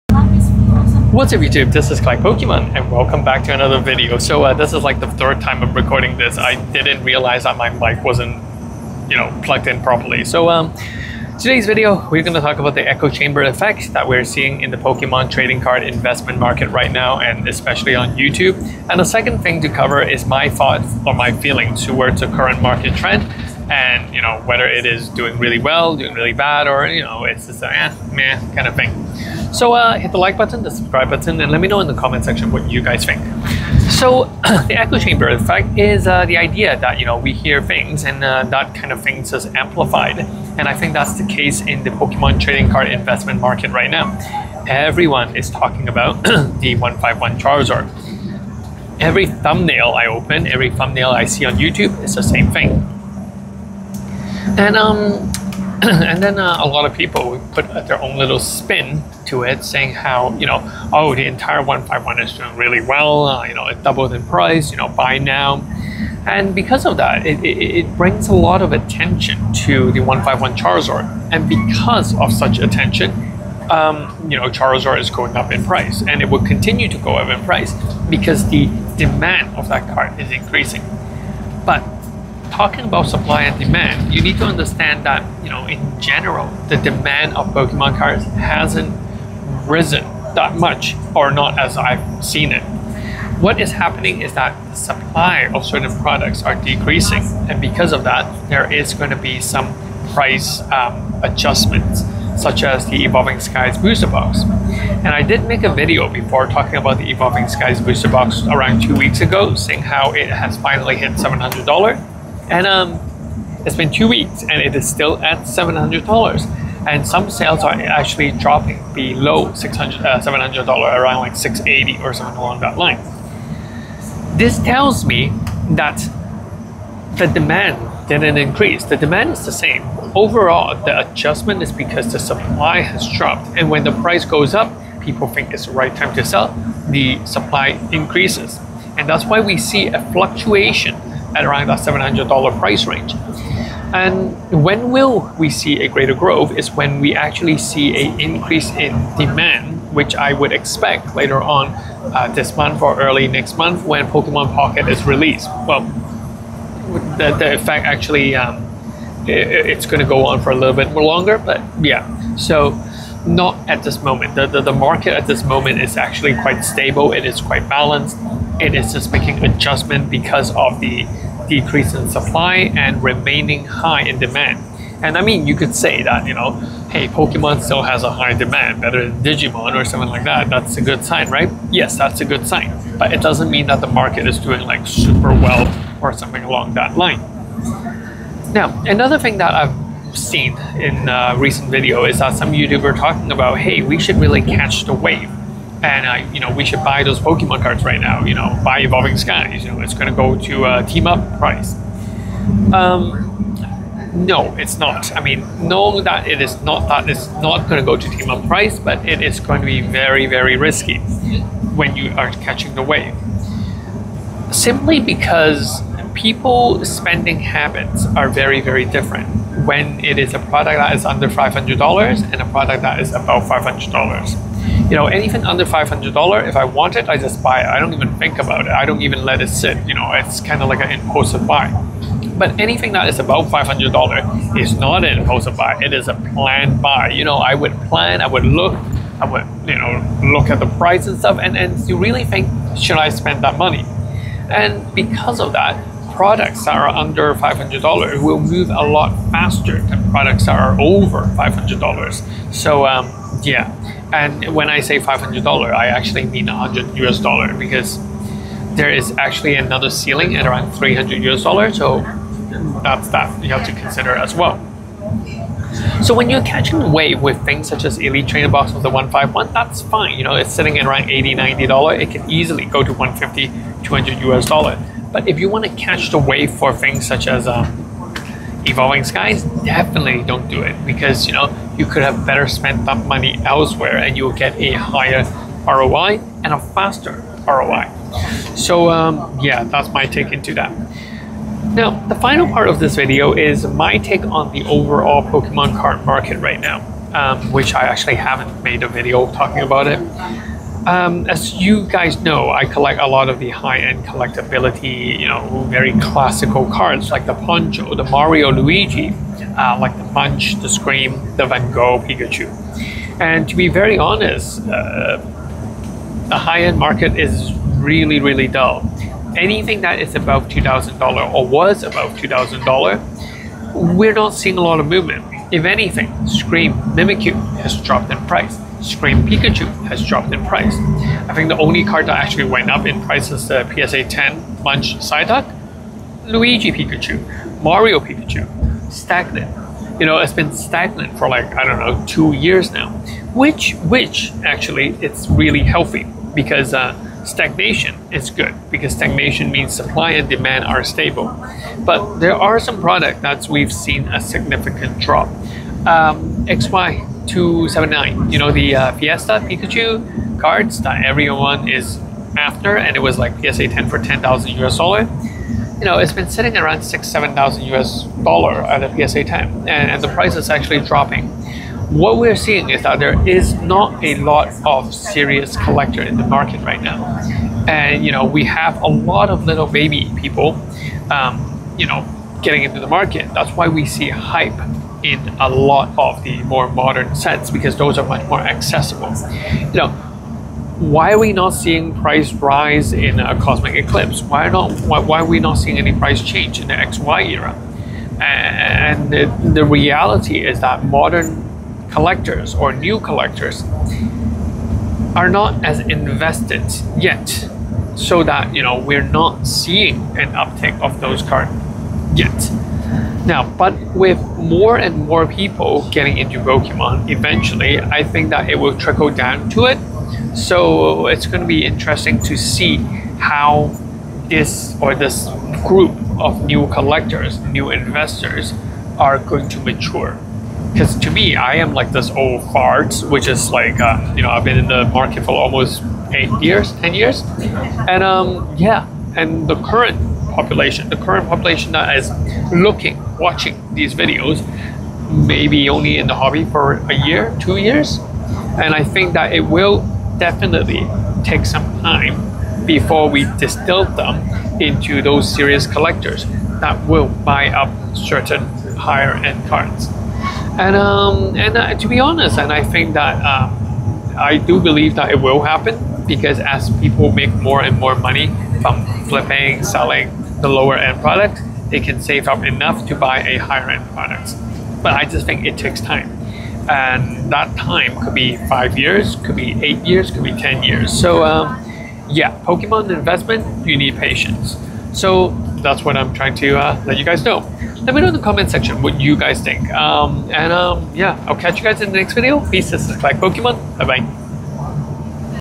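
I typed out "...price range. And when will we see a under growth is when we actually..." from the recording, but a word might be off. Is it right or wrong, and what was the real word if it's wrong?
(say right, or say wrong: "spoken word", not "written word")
wrong: "greater", not "under".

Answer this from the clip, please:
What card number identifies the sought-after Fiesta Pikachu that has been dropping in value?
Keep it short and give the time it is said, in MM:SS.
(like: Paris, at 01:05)
XY 279, at 05:56.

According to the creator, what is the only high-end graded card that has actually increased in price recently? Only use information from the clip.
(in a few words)
PSA 10 Munch Psyduck.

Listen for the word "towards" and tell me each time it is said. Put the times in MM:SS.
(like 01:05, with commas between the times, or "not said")
00:21.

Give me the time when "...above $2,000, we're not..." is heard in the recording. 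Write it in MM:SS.
05:21.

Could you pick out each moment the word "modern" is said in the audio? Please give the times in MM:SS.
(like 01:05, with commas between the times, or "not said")
06:26, 06:40.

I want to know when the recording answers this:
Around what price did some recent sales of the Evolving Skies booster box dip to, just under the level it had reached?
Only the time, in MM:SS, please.
02:01.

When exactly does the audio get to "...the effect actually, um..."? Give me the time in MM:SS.
02:37.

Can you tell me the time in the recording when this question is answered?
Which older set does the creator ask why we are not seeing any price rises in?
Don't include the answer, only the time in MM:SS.
06:33.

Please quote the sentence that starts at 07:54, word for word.
But I just think it takes time.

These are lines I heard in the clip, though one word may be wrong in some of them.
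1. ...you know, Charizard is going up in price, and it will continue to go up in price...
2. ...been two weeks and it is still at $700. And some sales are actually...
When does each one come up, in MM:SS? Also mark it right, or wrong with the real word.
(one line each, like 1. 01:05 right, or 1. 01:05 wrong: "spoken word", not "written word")
1. 01:14 right
2. 01:53 right.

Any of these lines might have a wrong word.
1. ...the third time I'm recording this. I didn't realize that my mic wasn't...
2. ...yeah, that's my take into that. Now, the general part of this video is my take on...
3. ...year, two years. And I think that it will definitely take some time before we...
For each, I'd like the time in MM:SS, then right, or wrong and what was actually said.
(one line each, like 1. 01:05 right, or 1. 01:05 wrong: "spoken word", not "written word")
1. 00:05 right
2. 04:49 wrong: "final", not "general"
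3. 07:27 right.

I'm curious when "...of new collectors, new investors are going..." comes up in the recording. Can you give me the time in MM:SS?
07:06.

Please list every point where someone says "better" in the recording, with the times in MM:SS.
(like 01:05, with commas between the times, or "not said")
02:58, 04:42.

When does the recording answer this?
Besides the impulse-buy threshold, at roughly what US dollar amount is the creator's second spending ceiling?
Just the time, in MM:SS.
04:20.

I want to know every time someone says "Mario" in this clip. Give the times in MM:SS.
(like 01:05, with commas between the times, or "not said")
05:08, 05:37.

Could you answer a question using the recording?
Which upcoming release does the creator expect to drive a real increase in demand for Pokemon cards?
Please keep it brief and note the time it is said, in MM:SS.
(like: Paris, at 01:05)
Pokemon Pocket, at 02:34.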